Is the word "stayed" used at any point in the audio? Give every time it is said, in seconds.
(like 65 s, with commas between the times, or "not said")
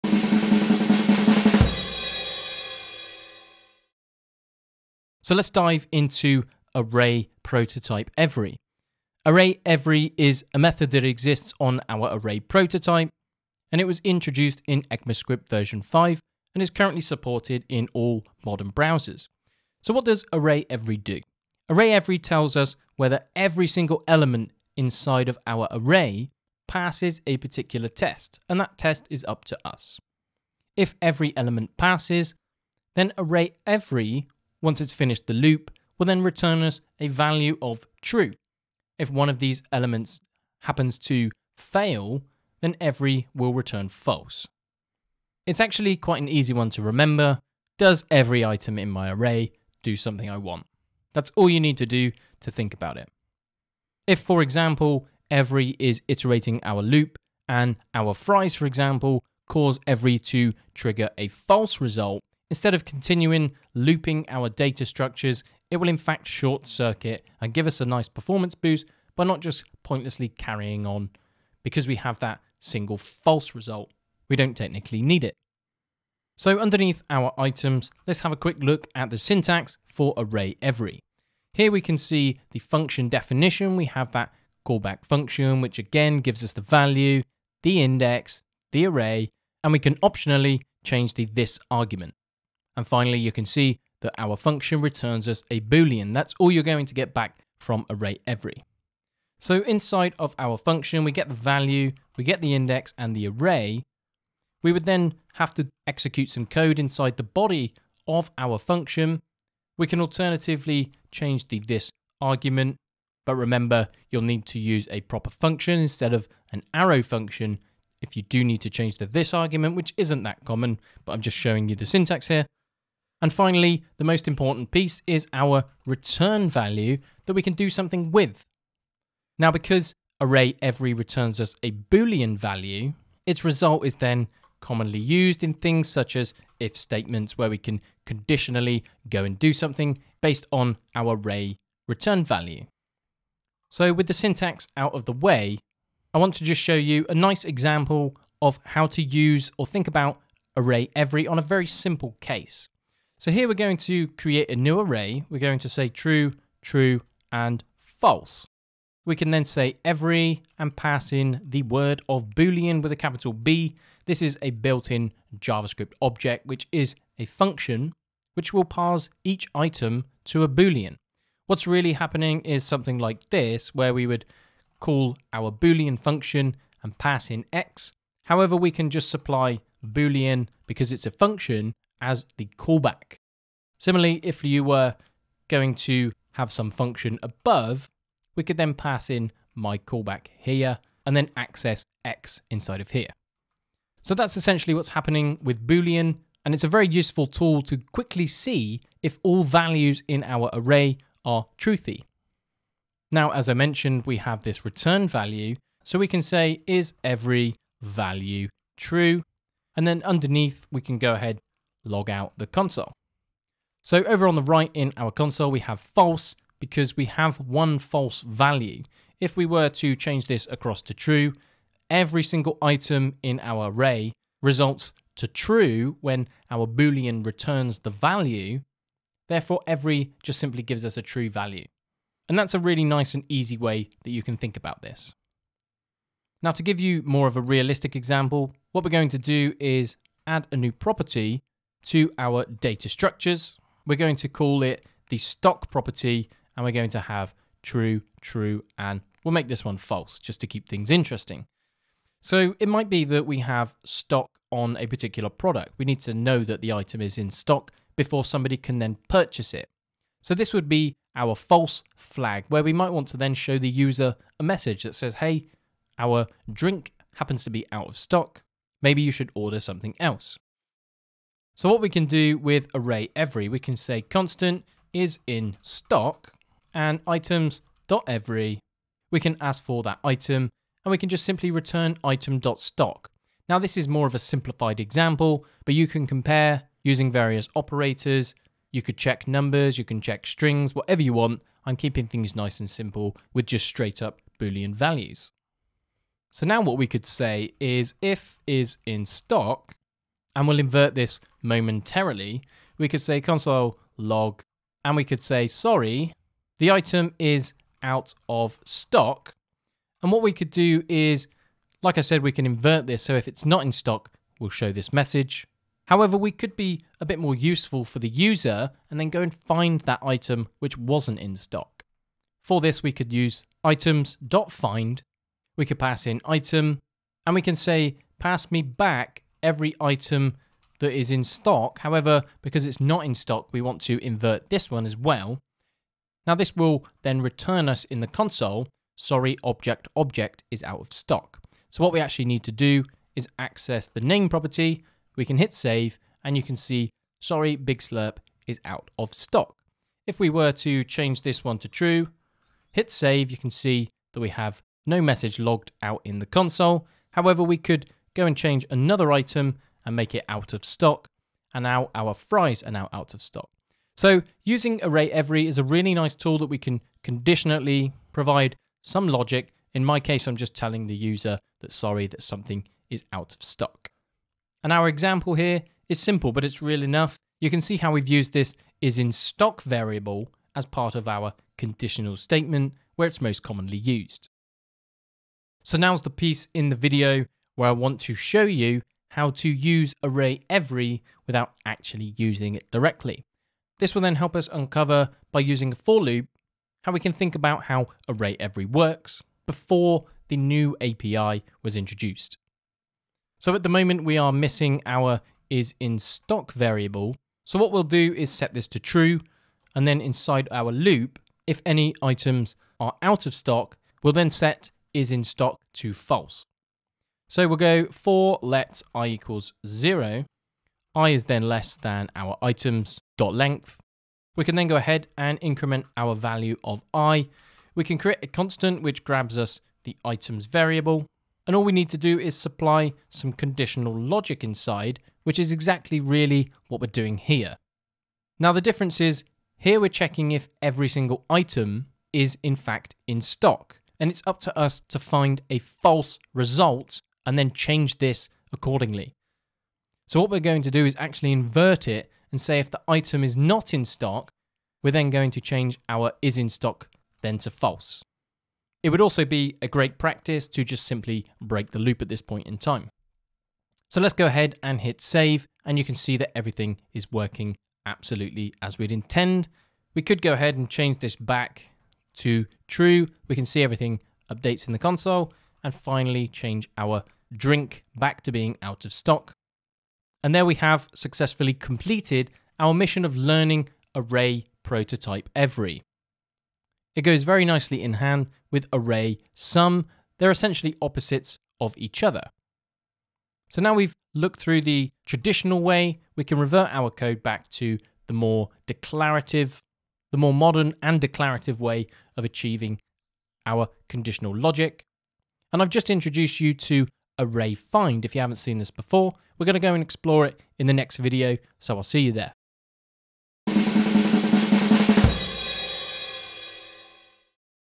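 not said.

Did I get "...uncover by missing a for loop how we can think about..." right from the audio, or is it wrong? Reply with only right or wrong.
wrong.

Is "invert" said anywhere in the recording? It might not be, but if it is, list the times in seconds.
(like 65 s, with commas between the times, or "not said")
300 s, 312 s, 334 s, 451 s.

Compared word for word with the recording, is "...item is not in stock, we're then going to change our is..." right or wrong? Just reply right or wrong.
right.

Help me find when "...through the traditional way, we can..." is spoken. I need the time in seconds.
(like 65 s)
494 s.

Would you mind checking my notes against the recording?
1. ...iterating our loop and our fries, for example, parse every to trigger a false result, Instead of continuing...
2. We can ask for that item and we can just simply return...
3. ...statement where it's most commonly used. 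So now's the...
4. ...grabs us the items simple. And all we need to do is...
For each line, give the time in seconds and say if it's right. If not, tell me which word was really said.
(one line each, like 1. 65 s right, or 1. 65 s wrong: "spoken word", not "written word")
1. 56 s wrong: "cause", not "parse"
2. 279 s right
3. 382 s right
4. 429 s wrong: "variable", not "simple".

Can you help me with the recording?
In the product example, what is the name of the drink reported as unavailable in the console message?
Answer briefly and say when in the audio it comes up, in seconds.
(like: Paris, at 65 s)
Big Slurp, at 347 s.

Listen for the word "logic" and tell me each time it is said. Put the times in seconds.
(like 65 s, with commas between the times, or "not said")
369 s, 433 s, 504 s.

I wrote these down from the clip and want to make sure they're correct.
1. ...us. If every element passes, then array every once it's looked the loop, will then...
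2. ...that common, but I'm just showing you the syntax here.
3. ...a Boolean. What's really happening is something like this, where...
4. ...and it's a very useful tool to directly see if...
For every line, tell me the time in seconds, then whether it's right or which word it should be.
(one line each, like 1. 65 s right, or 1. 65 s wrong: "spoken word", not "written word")
1. 29 s wrong: "finished", not "looked"
2. 120 s right
3. 170 s right
4. 196 s wrong: "quickly", not "directly".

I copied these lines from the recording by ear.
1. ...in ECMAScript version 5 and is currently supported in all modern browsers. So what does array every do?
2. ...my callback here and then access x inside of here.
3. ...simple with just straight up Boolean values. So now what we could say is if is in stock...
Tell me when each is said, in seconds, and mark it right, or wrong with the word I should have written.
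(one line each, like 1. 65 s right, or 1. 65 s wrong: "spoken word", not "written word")
1. 14 s right
2. 189 s right
3. 292 s right.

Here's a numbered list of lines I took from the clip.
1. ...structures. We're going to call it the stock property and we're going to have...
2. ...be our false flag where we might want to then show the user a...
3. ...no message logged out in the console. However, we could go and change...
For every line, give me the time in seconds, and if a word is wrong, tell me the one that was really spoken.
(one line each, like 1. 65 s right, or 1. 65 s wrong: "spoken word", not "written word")
1. 242 s right
2. 260 s right
3. 354 s right.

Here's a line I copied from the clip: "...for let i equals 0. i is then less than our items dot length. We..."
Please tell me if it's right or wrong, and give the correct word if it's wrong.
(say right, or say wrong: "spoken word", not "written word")
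right.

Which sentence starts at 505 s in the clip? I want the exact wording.
And I've just introduced you to Array Find.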